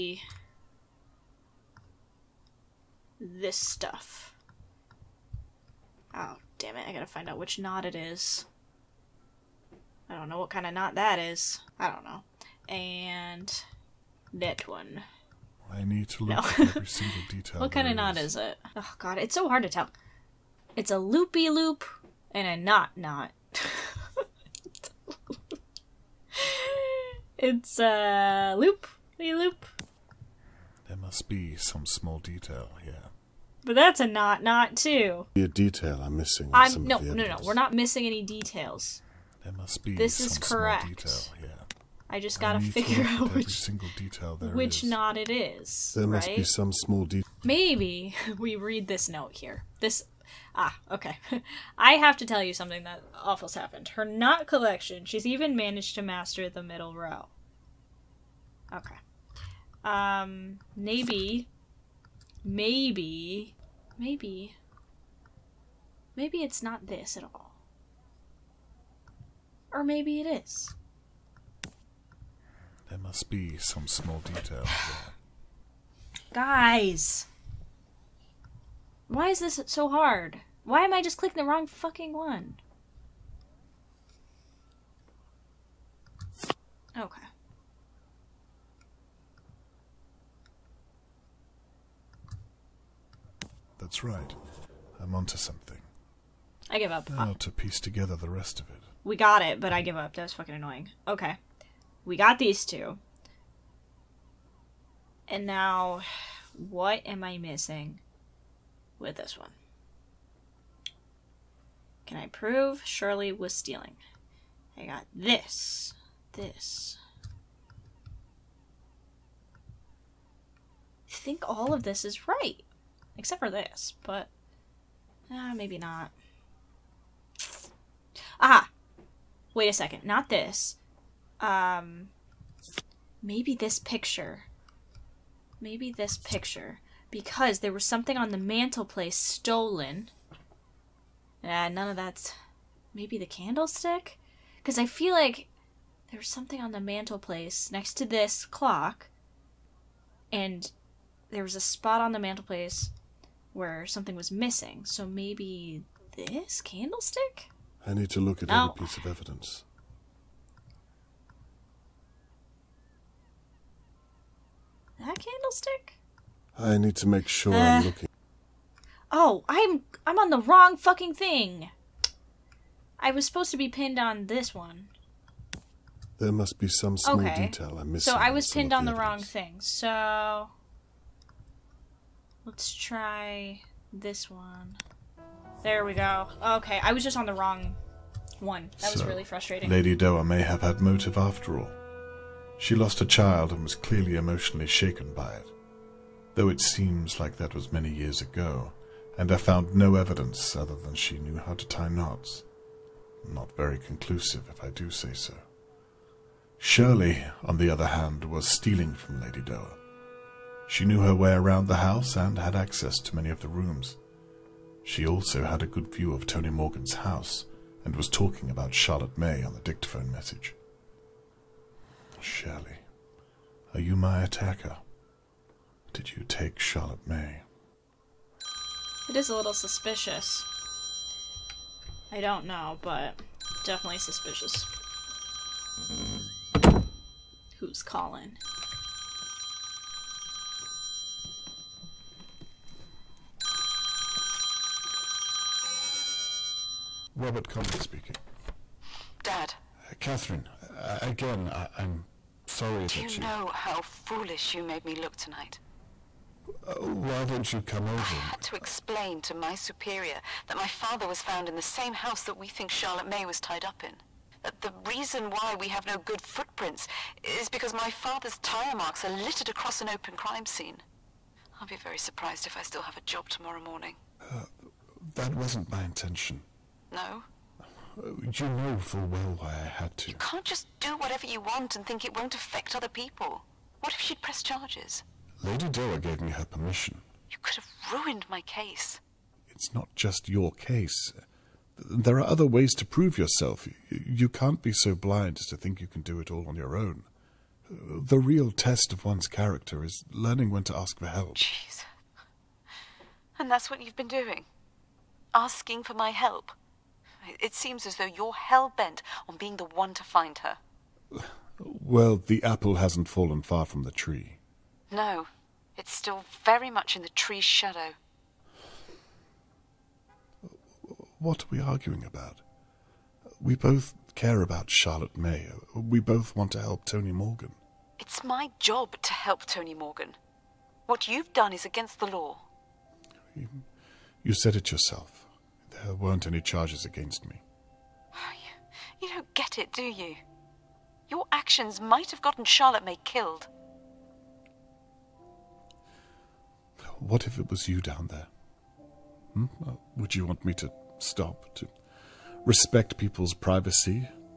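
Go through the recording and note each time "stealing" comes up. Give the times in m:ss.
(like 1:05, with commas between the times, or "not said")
1:53, 3:28.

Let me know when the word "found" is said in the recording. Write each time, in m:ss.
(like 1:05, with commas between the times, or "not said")
3:19, 4:21.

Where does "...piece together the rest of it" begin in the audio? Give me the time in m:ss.
1:37.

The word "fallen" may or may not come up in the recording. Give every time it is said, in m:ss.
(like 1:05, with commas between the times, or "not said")
5:13.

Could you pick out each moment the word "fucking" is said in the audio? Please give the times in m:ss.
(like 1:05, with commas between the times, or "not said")
1:21, 1:40, 2:50.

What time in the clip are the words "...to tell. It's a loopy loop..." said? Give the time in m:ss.
0:19.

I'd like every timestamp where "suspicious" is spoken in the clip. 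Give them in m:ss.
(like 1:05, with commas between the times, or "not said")
3:49, 3:53.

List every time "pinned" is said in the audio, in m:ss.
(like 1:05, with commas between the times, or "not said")
2:53, 2:58.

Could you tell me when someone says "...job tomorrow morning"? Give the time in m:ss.
4:33.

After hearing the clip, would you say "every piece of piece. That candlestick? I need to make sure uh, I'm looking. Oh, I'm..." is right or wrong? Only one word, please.
wrong.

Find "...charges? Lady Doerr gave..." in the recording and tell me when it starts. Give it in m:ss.
4:44.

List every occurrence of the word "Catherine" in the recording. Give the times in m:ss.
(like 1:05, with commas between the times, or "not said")
4:09.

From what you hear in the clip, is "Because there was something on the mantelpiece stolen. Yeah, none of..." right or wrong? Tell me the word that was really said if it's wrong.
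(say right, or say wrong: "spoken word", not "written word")
right.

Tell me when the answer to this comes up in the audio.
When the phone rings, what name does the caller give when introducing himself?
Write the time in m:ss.
4:07.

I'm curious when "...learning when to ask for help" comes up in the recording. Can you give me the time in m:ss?
5:00.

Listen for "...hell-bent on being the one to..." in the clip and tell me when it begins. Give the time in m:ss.
5:08.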